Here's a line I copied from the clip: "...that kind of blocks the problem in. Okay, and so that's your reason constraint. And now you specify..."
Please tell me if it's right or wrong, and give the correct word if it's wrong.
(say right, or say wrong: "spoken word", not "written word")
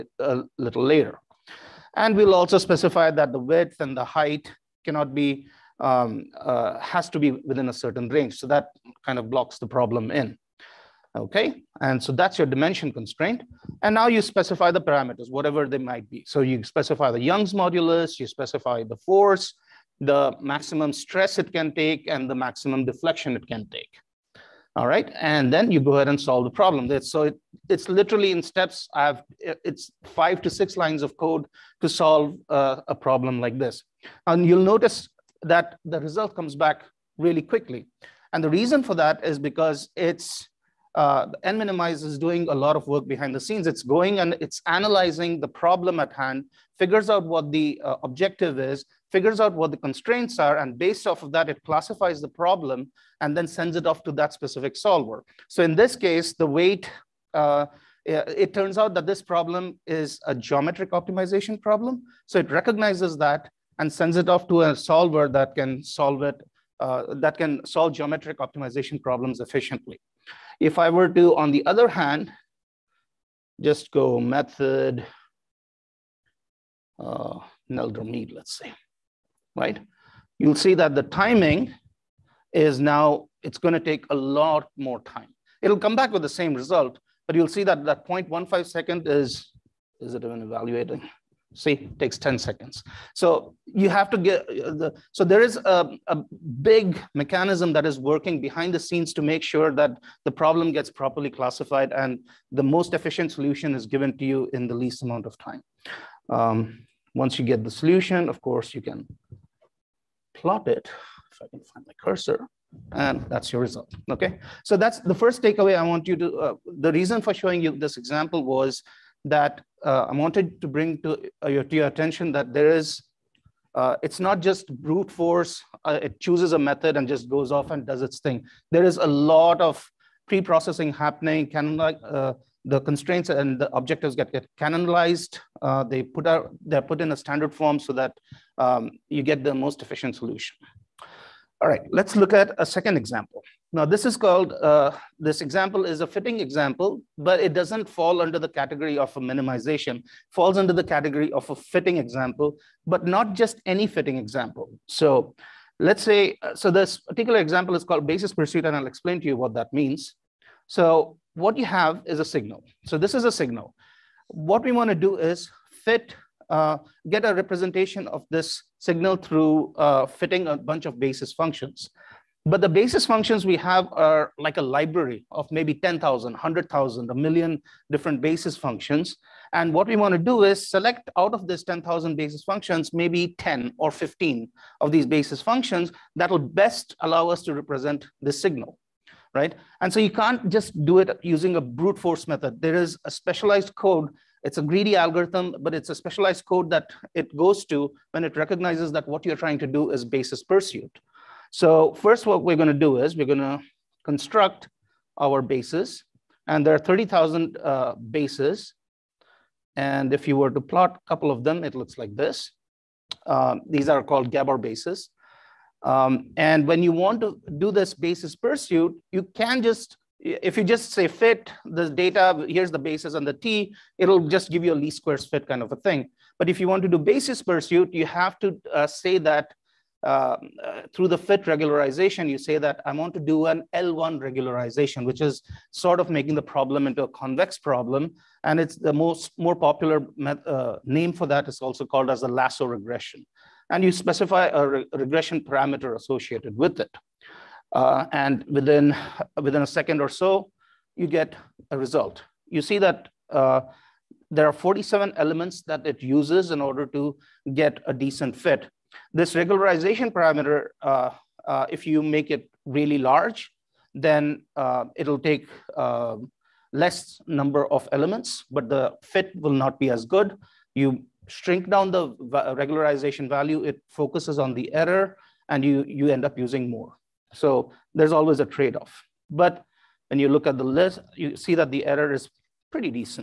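wrong: "dimension", not "reason".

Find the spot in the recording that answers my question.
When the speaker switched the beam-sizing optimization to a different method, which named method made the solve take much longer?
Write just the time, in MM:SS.
01:17.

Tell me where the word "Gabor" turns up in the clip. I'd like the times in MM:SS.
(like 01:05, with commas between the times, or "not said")
03:34.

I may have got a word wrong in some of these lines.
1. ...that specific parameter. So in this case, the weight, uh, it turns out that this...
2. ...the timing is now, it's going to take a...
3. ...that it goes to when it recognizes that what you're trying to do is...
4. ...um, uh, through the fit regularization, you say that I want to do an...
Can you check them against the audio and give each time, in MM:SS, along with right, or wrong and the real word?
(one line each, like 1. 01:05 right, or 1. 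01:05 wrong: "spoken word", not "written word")
1. 00:54 wrong: "solver", not "parameter"
2. 01:20 right
3. 03:16 right
4. 03:50 right.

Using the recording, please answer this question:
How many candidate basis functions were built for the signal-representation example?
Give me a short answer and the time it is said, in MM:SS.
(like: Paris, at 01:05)
30,000, at 03:26.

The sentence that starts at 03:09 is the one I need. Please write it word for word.
And so you can't just do it using a brute force method.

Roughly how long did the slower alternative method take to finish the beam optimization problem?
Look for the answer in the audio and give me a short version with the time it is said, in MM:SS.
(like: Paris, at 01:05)
10 seconds, at 01:32.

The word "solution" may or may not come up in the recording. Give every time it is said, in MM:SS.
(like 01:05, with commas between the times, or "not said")
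01:43, 01:47, 02:20.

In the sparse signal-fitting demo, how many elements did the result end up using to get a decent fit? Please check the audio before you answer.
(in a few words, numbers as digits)
47.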